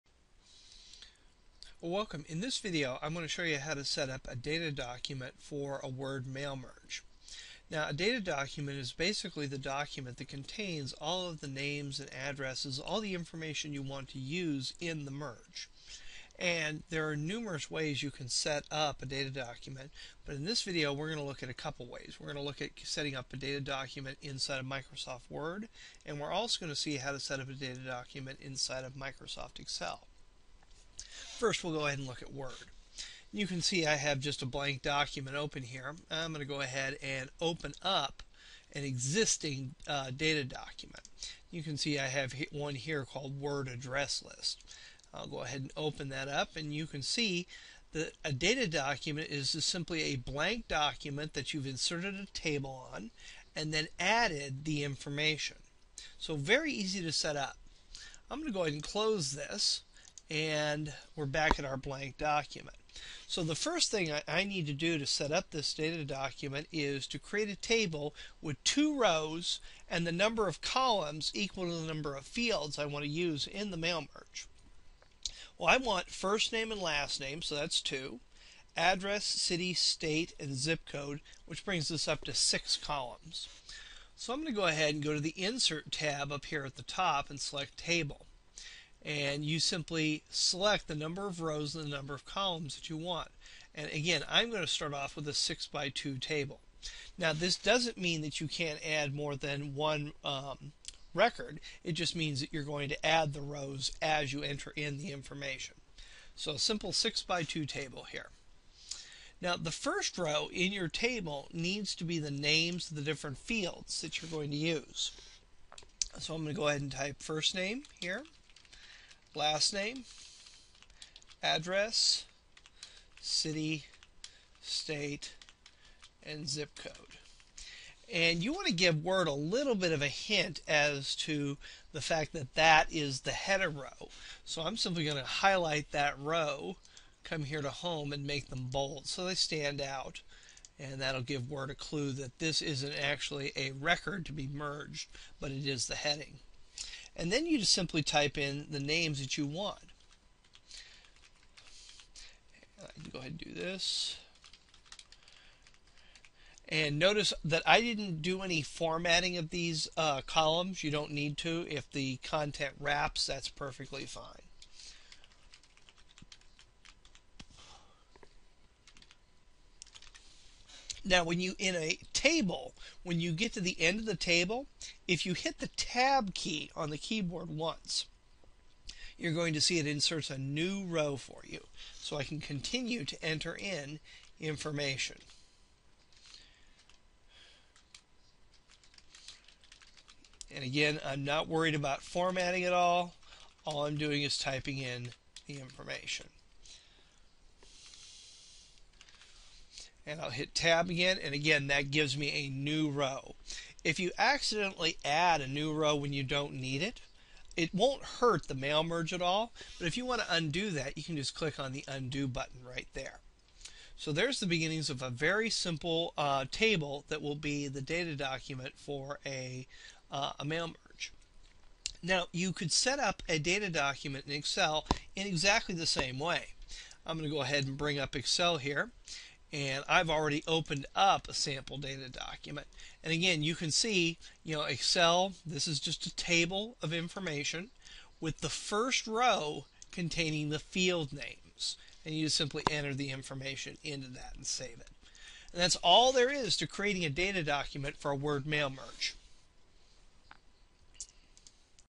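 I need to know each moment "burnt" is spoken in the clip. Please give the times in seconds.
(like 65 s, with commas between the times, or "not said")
not said.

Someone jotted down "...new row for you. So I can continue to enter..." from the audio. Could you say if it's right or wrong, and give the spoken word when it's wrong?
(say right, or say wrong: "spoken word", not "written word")
right.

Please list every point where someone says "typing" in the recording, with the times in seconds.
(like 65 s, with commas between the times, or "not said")
194 s.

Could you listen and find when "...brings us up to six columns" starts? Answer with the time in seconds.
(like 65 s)
81 s.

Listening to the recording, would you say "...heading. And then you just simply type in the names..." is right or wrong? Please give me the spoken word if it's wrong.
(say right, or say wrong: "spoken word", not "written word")
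right.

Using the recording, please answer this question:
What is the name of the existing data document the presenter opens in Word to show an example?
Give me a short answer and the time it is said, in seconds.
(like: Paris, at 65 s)
Word Address List, at 43 s.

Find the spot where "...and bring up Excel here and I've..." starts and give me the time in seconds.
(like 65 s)
227 s.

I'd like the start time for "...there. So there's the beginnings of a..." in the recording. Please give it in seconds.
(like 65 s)
212 s.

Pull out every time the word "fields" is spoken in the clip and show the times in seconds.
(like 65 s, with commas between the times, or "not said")
72 s, 113 s, 240 s.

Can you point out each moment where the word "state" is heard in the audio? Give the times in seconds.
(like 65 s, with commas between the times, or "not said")
79 s, 124 s.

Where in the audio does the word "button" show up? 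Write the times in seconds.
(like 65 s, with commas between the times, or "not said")
212 s.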